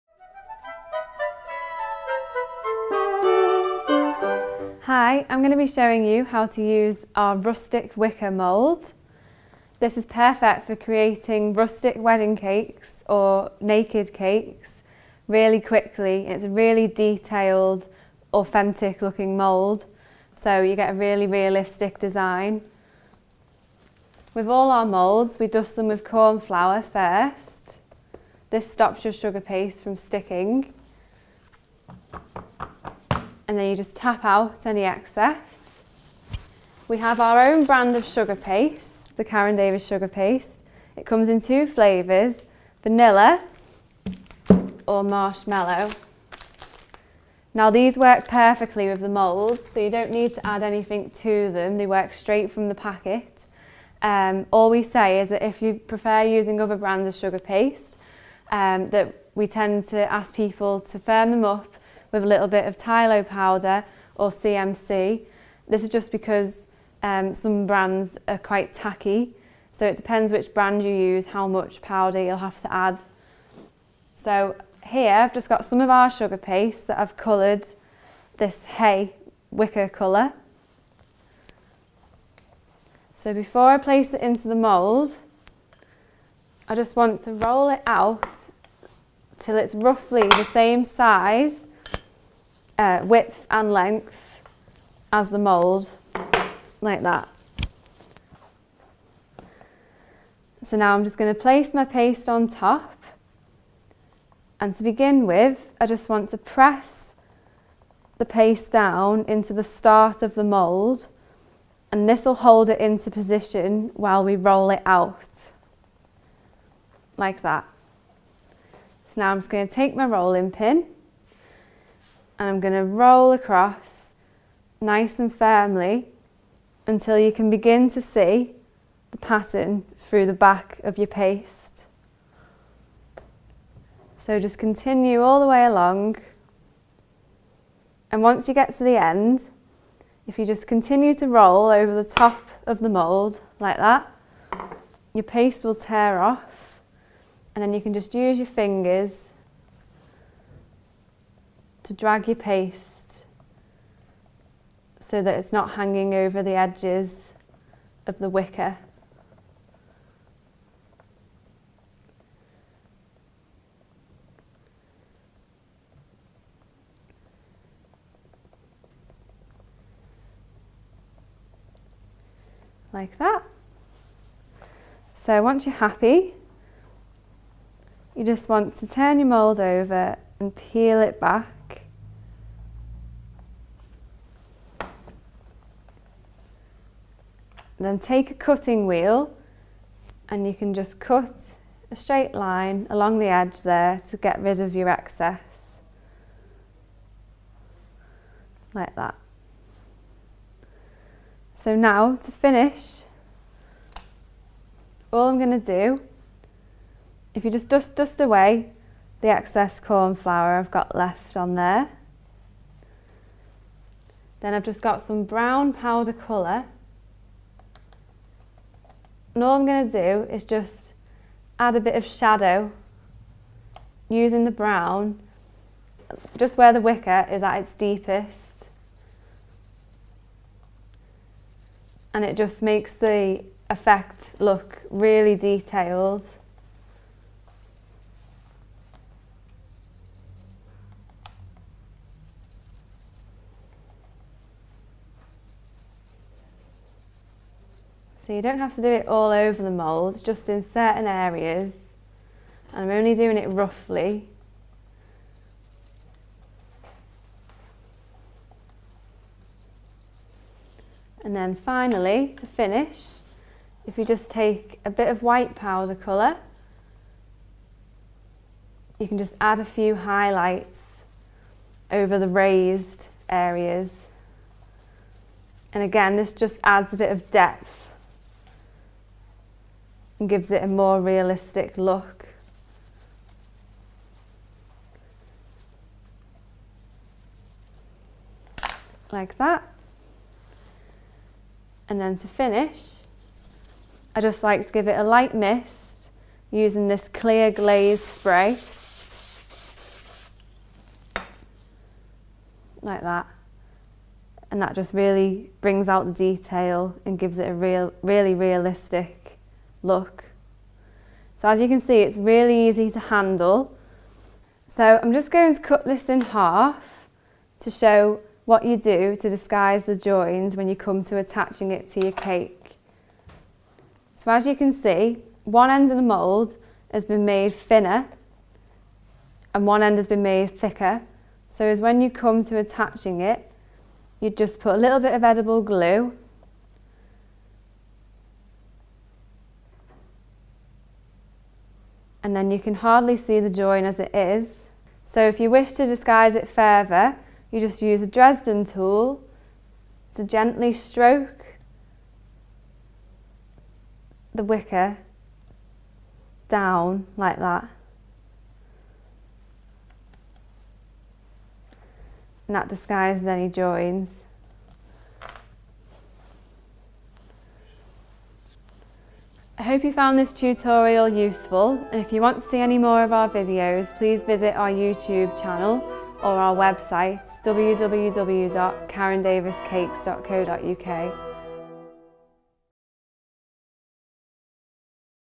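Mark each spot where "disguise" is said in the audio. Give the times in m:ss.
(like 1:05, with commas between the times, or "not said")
5:19, 5:45, 6:02.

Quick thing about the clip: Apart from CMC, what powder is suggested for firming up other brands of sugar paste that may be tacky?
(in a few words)
Tylo powder.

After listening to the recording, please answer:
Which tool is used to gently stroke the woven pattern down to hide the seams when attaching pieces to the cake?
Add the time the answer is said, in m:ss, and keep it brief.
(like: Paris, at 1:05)
Dresden tool, at 5:48.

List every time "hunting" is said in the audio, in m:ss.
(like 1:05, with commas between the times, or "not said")
not said.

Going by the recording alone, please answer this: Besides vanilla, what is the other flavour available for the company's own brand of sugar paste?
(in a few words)
marshmallow.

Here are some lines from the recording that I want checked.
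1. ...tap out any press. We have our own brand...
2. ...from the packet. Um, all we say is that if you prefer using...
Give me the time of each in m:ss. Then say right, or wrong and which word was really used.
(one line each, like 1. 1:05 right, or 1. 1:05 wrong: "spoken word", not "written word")
1. 0:33 wrong: "excess", not "press"
2. 0:52 right.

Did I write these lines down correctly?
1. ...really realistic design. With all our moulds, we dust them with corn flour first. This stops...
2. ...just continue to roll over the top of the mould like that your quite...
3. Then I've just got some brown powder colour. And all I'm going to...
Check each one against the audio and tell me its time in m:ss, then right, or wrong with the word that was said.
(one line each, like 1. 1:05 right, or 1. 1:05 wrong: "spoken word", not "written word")
1. 0:20 right
2. 2:20 wrong: "paste", not "quite"
3. 3:34 right.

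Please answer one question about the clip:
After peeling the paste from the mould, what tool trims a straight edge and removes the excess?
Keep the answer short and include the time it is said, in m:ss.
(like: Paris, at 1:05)
cutting wheel, at 3:08.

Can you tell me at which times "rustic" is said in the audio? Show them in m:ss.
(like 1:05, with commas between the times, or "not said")
0:07, 0:11.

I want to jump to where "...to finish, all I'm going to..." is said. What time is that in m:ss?
3:22.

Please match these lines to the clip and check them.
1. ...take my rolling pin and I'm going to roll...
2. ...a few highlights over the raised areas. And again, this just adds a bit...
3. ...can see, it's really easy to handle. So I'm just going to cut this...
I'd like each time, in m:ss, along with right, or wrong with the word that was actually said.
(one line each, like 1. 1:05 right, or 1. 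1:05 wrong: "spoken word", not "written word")
1. 1:59 right
2. 4:29 right
3. 5:11 right.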